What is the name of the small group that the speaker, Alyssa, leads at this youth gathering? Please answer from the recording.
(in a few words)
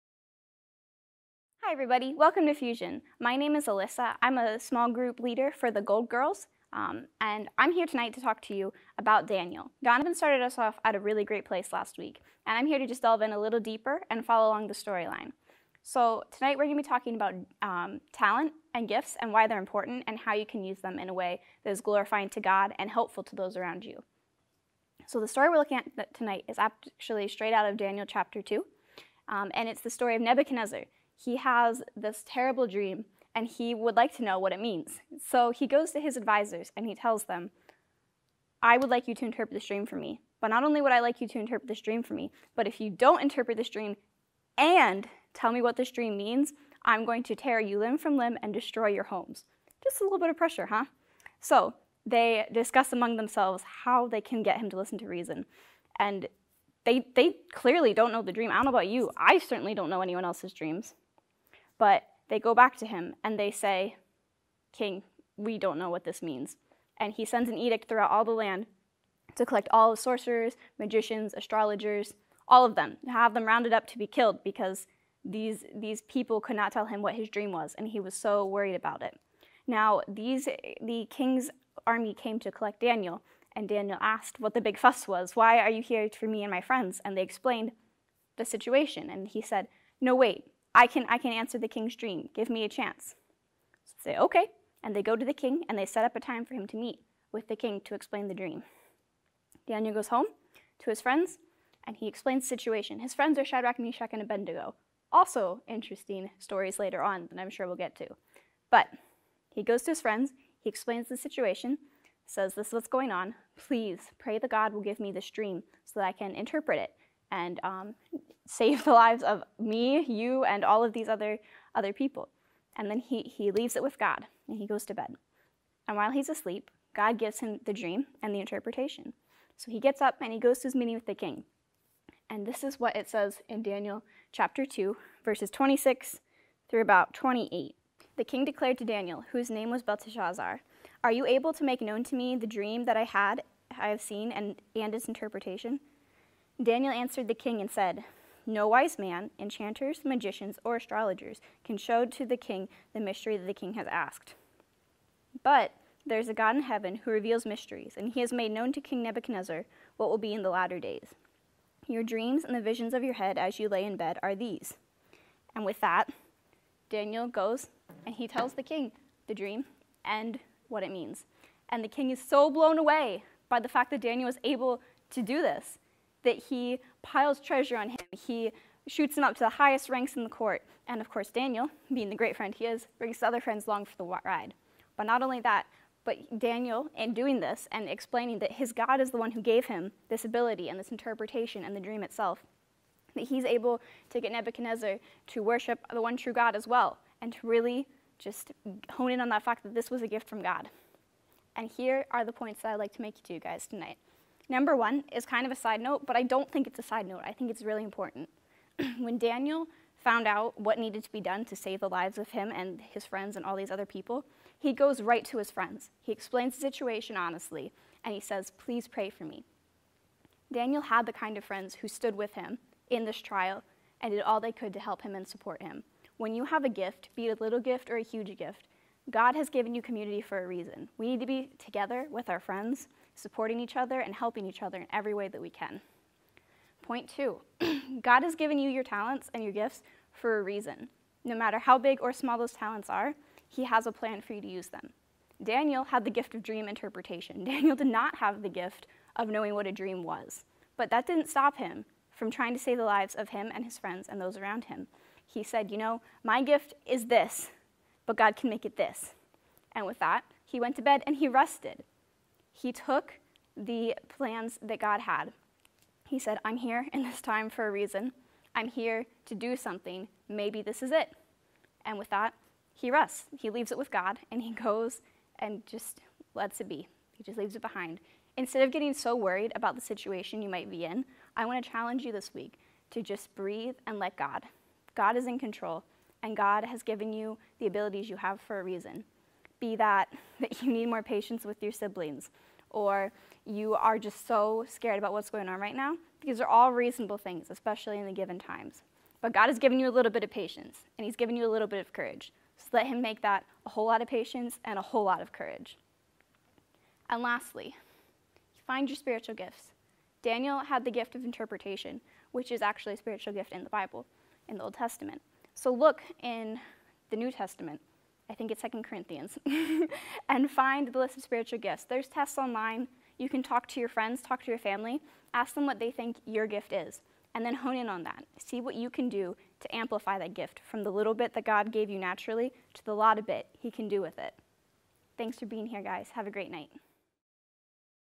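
Gold Girls.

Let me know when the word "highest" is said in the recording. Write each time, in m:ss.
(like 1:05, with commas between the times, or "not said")
2:59.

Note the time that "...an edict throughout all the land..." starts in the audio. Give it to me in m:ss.
1:07.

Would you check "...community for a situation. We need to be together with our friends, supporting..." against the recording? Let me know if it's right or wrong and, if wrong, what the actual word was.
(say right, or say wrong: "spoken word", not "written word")
wrong: "reason", not "situation".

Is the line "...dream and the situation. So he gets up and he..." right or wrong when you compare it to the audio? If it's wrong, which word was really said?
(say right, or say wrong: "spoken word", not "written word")
wrong: "interpretation", not "situation".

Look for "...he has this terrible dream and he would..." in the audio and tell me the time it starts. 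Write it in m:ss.
0:31.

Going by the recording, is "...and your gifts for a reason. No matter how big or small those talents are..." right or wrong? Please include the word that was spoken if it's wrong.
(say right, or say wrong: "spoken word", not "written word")
right.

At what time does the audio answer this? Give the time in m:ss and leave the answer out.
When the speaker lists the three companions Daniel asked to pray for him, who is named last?
1:44.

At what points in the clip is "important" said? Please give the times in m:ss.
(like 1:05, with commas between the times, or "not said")
0:19, 3:27.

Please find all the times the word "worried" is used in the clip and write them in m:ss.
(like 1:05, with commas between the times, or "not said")
1:18, 4:39.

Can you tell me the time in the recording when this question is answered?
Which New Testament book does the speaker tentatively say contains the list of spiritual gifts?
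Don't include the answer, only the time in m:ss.
5:18.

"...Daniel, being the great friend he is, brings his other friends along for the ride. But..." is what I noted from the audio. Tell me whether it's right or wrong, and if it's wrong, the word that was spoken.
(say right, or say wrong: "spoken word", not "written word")
right.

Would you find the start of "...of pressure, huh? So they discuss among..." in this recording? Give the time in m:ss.
0:50.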